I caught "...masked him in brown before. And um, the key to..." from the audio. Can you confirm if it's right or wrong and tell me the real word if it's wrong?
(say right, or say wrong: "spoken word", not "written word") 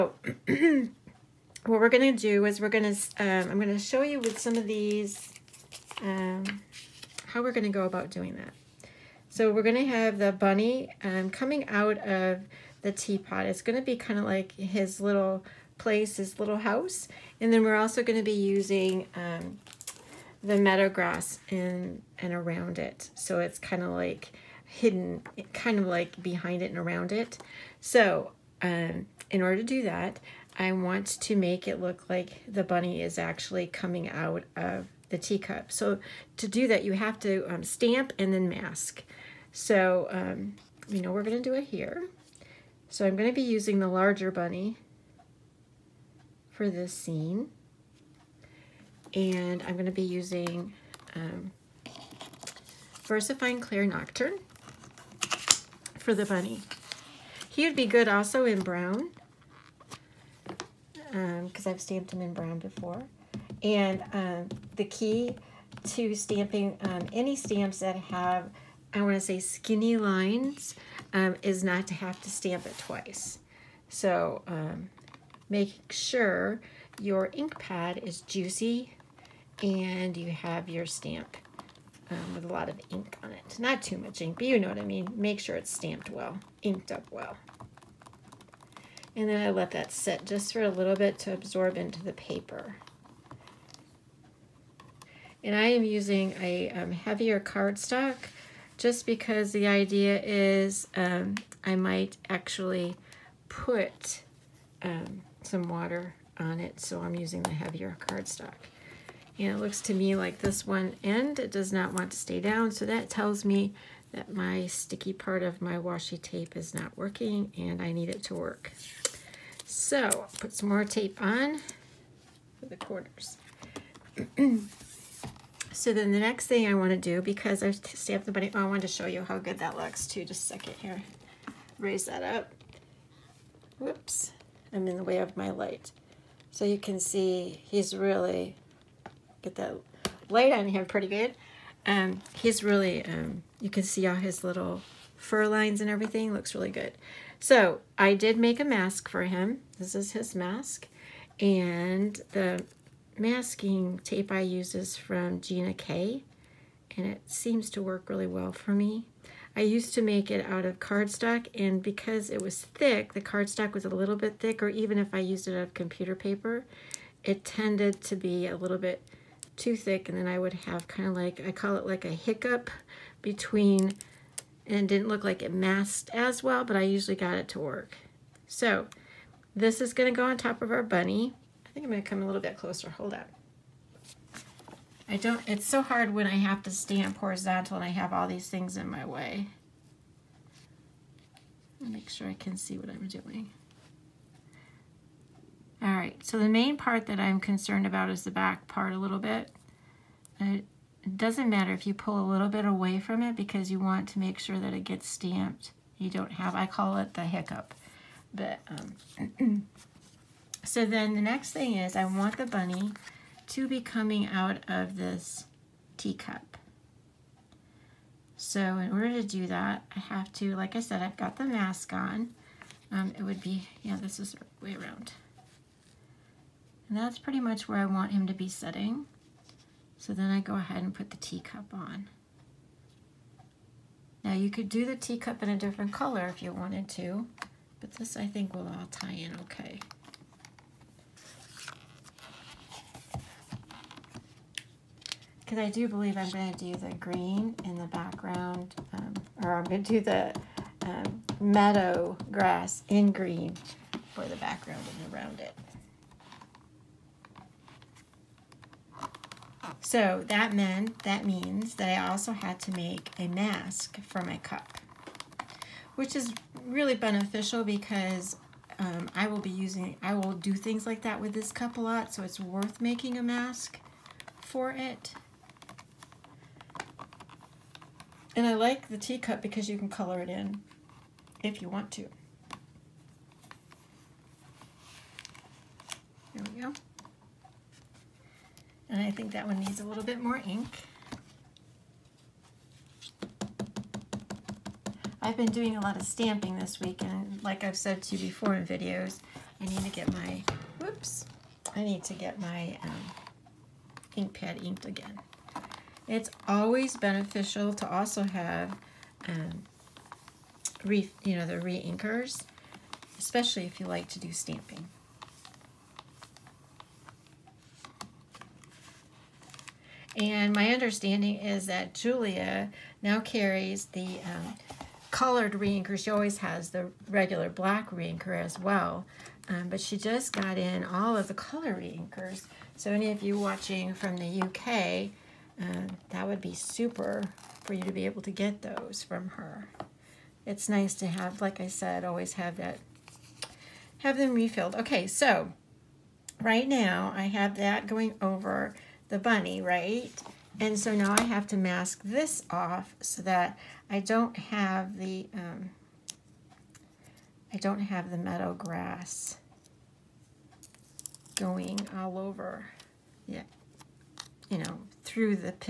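wrong: "stamped", not "masked".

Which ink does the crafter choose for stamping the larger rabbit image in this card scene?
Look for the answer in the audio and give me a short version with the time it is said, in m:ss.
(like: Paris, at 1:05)
VersaFine Clair Nocturne, at 0:53.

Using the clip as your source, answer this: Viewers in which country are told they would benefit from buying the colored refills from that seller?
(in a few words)
UK.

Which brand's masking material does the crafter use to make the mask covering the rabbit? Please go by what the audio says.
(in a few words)
Gina K.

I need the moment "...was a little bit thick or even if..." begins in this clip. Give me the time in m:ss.
2:43.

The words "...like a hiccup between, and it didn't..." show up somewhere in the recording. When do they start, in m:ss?
2:51.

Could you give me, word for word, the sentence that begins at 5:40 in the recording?
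It's nice to have, like I said, always have that, have them refilled.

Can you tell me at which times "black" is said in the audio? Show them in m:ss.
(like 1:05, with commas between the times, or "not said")
5:27.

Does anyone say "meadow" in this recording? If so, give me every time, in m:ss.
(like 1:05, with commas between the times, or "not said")
0:20, 4:11, 5:58.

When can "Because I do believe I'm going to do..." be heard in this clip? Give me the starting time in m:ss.
4:05.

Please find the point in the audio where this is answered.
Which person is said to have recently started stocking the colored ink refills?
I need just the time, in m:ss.
5:21.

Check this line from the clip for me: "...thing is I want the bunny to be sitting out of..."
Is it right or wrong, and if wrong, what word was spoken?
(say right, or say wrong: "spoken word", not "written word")
wrong: "coming", not "sitting".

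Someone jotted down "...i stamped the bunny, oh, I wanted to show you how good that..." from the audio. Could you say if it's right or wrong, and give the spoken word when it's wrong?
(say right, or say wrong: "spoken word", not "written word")
right.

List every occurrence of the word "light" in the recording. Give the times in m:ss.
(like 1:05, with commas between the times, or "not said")
2:15, 2:20.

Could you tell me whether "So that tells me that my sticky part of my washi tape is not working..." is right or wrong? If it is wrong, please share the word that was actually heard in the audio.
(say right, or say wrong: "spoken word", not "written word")
right.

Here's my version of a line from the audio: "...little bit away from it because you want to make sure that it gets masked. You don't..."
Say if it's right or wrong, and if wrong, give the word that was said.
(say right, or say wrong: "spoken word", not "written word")
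wrong: "stamped", not "masked".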